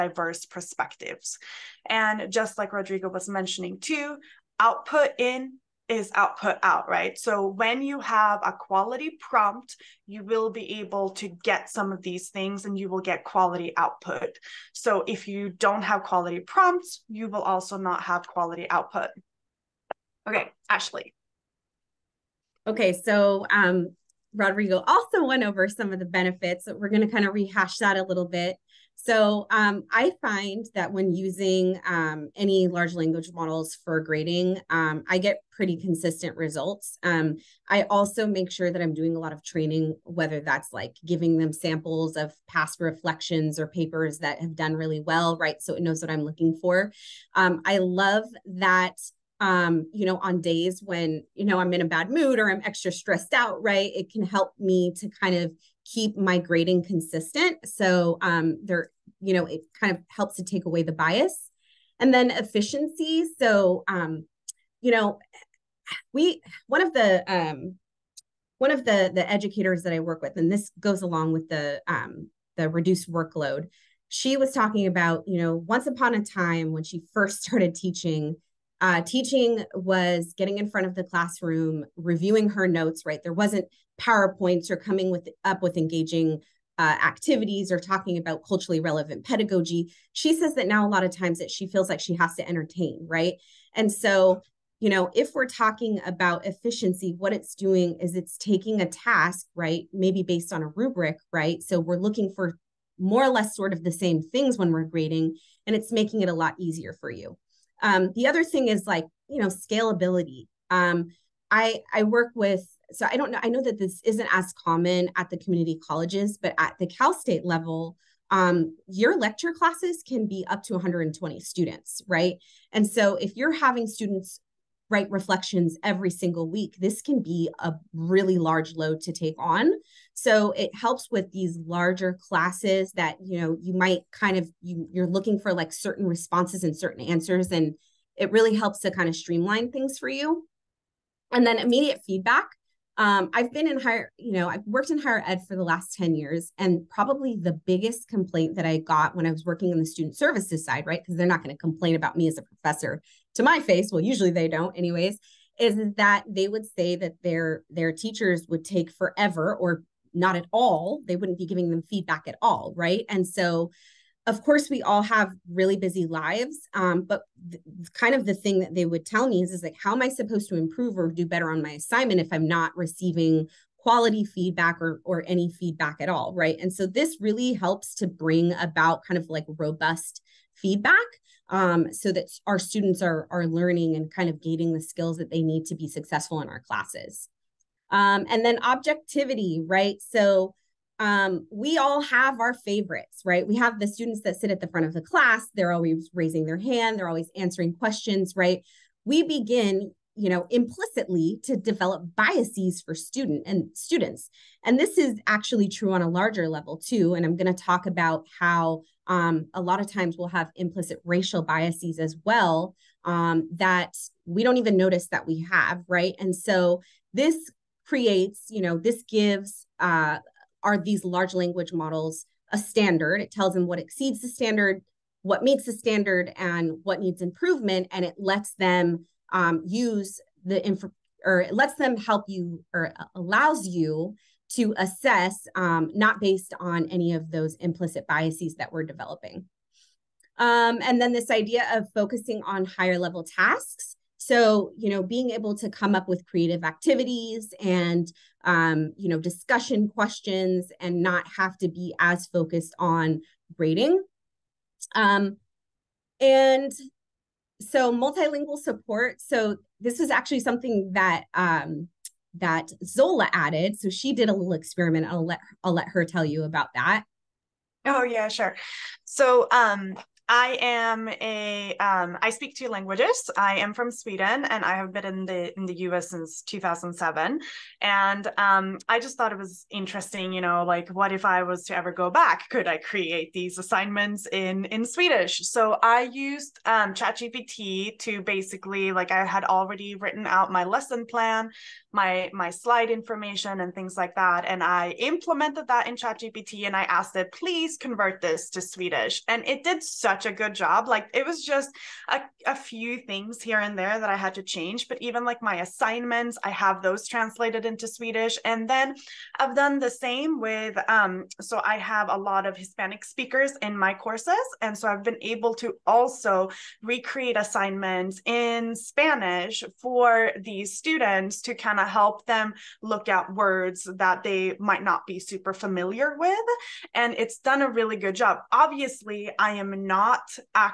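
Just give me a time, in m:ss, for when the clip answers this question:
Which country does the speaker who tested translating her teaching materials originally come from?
4:33.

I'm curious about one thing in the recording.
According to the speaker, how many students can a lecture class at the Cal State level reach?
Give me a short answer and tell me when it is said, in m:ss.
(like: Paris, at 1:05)
120, at 2:00.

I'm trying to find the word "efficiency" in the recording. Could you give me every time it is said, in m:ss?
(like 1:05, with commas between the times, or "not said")
1:02, 1:36.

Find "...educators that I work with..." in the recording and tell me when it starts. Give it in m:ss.
1:09.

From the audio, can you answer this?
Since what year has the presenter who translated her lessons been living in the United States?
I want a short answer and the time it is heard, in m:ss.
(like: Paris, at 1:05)
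2007, at 4:36.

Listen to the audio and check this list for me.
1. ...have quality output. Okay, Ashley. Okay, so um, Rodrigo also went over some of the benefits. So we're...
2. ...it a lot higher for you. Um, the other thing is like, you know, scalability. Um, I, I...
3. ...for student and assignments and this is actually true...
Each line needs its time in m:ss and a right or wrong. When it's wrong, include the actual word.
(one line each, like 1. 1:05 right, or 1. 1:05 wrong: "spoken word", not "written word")
1. 0:18 right
2. 1:46 wrong: "easier", not "higher"
3. 3:22 wrong: "students", not "assignments".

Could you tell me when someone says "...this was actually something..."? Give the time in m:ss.
4:19.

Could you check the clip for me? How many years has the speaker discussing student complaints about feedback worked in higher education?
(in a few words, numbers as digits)
10 years.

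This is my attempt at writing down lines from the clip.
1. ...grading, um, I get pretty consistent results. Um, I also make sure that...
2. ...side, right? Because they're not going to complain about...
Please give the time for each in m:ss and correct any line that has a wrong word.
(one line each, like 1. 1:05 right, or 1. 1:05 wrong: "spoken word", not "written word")
1. 0:33 right
2. 2:30 right.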